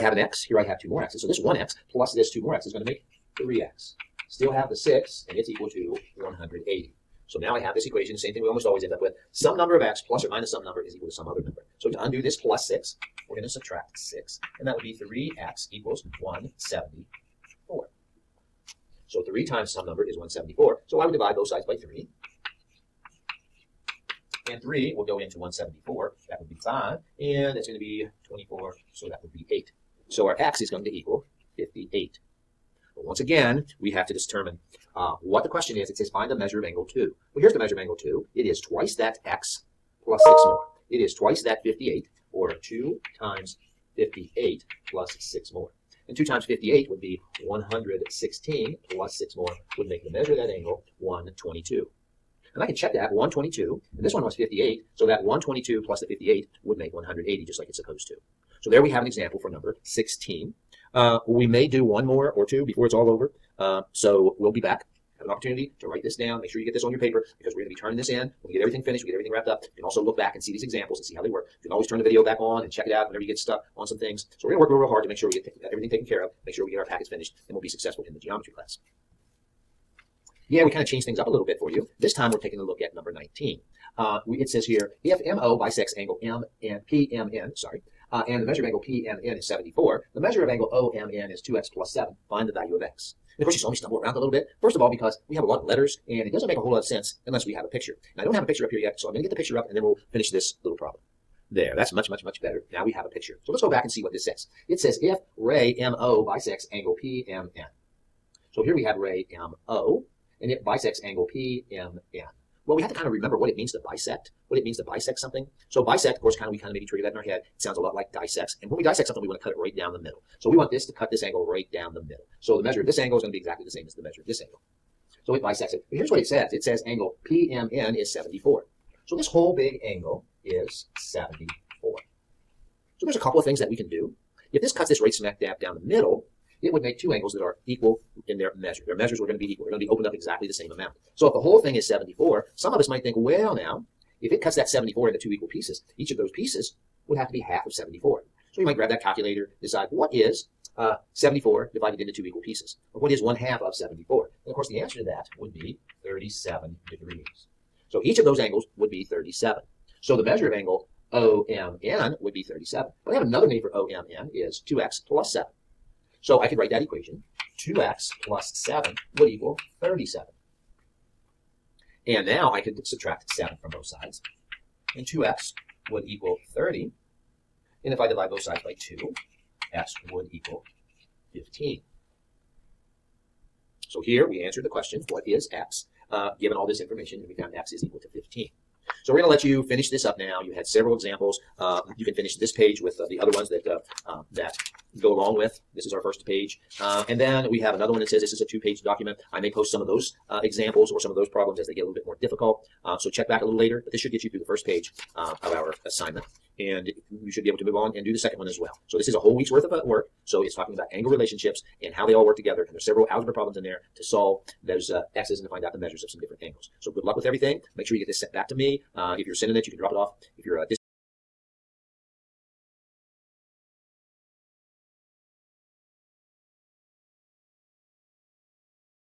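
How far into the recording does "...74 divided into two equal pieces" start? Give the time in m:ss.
2:31.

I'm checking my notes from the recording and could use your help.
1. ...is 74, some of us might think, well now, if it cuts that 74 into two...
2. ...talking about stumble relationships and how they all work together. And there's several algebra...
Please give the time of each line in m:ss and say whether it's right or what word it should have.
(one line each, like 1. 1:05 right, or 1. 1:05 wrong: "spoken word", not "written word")
1. 2:21 right
2. 3:30 wrong: "angle", not "stumble".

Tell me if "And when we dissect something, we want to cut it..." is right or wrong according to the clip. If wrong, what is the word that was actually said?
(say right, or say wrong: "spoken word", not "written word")
right.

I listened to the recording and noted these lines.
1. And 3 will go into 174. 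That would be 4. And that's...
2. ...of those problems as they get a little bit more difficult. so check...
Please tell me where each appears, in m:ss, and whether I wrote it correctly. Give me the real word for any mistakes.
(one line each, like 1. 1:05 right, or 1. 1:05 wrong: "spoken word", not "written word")
1. 0:24 wrong: "5", not "4"
2. 3:21 right.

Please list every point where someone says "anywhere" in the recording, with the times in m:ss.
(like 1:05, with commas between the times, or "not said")
not said.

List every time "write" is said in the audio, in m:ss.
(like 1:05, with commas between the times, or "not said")
1:05, 2:46.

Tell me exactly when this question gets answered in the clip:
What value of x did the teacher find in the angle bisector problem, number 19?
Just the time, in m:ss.
2:59.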